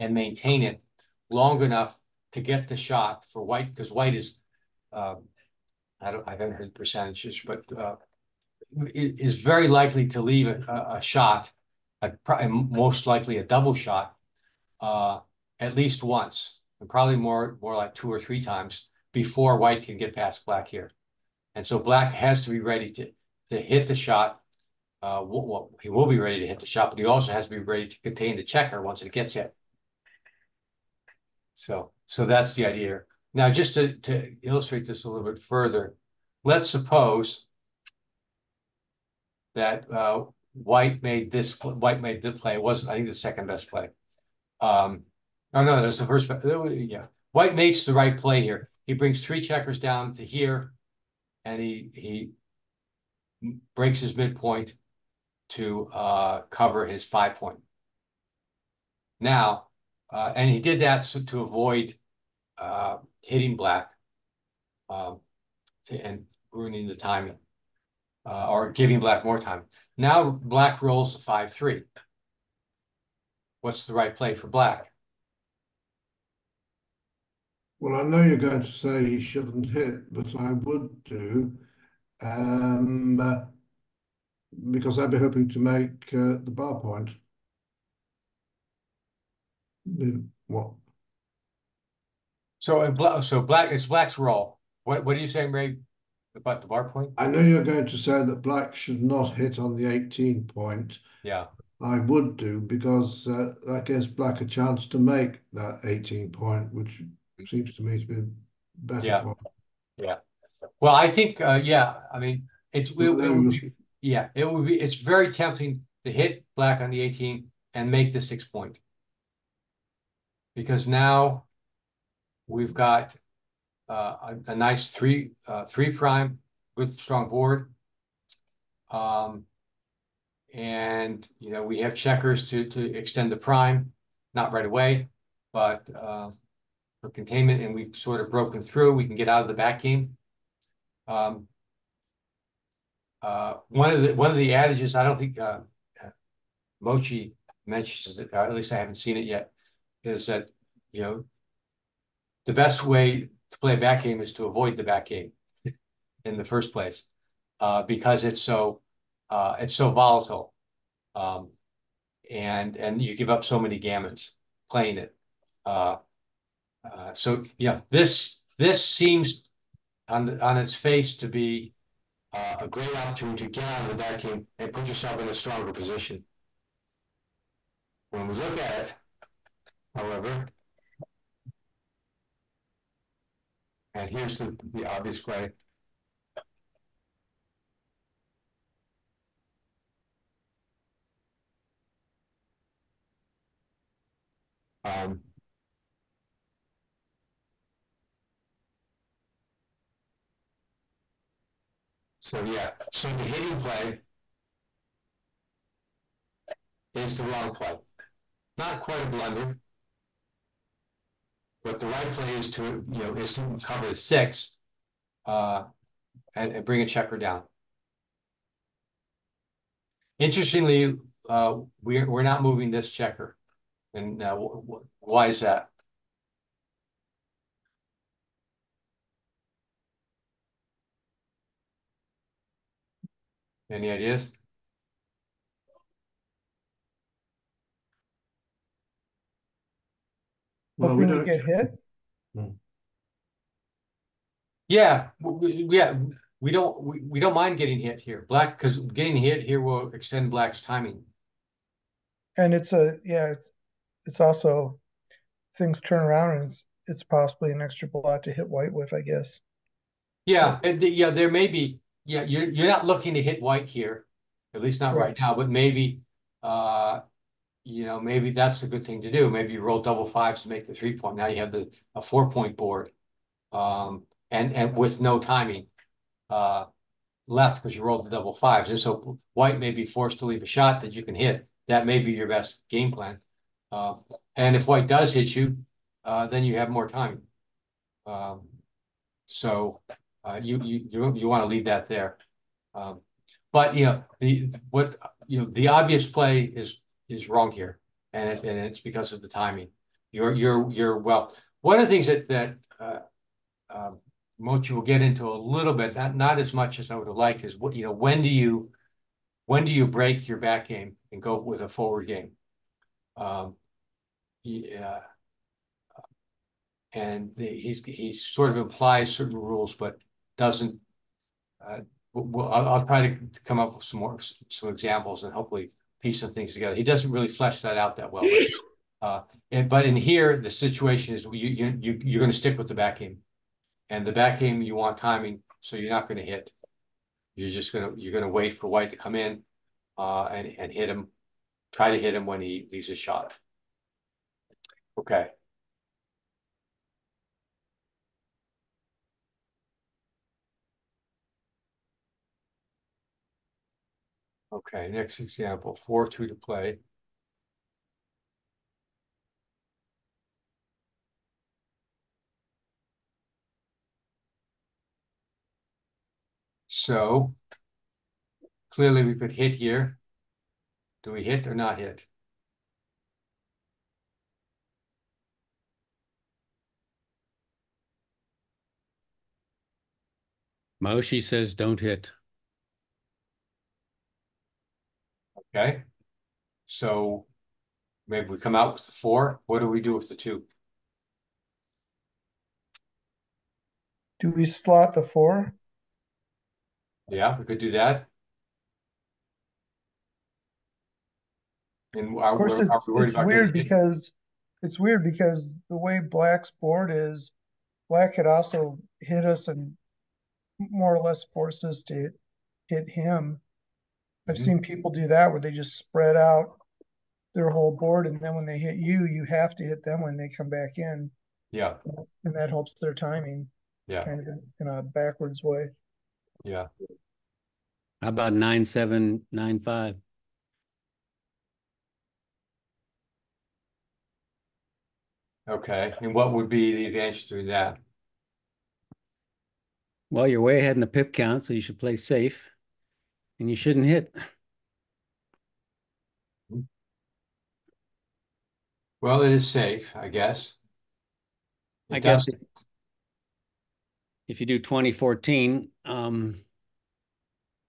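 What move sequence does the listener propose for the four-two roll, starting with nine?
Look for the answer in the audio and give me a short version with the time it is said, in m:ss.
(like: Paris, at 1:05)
9/7 9/5, at 7:08.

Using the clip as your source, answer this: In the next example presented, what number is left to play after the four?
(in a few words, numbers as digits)
2.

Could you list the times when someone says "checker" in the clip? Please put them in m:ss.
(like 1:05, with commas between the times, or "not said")
0:28, 0:49, 2:11, 3:36, 3:42.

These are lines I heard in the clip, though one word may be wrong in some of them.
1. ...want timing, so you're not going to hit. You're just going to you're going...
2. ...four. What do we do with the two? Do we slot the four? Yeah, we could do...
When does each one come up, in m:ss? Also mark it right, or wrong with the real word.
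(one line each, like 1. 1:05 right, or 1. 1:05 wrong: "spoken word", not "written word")
1. 5:34 right
2. 6:28 right.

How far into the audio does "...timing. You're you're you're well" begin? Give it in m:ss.
4:59.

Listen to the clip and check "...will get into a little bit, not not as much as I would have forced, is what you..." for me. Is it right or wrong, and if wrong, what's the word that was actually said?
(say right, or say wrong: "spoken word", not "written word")
wrong: "liked", not "forced".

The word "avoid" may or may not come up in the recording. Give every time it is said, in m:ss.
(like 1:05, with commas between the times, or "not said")
1:01, 2:34.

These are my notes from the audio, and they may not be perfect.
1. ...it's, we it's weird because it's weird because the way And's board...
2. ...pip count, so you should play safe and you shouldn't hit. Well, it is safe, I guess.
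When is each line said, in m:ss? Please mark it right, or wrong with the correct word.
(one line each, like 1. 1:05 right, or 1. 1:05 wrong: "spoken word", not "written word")
1. 6:42 wrong: "Black", not "And"
2. 7:20 right.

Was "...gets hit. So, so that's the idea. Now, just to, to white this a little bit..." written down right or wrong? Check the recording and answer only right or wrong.
wrong.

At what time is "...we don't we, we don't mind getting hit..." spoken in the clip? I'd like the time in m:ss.
4:06.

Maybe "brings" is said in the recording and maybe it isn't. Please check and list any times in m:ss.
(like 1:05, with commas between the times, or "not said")
0:48, 3:36.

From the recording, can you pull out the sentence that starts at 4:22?
Yeah, you're you're not looking to hit white here, at least not right, right now.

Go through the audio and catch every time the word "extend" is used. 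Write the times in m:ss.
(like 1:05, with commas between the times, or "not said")
2:12, 4:09.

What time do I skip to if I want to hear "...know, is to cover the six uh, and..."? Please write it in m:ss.
3:33.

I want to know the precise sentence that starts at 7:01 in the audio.
Yeah, and that helps their timing.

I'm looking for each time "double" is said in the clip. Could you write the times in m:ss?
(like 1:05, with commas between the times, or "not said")
0:13, 4:29, 4:38.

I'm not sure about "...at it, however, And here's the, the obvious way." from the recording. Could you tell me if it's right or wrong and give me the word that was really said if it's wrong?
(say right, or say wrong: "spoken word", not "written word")
right.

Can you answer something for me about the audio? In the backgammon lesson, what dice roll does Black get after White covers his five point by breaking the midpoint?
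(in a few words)
5-3.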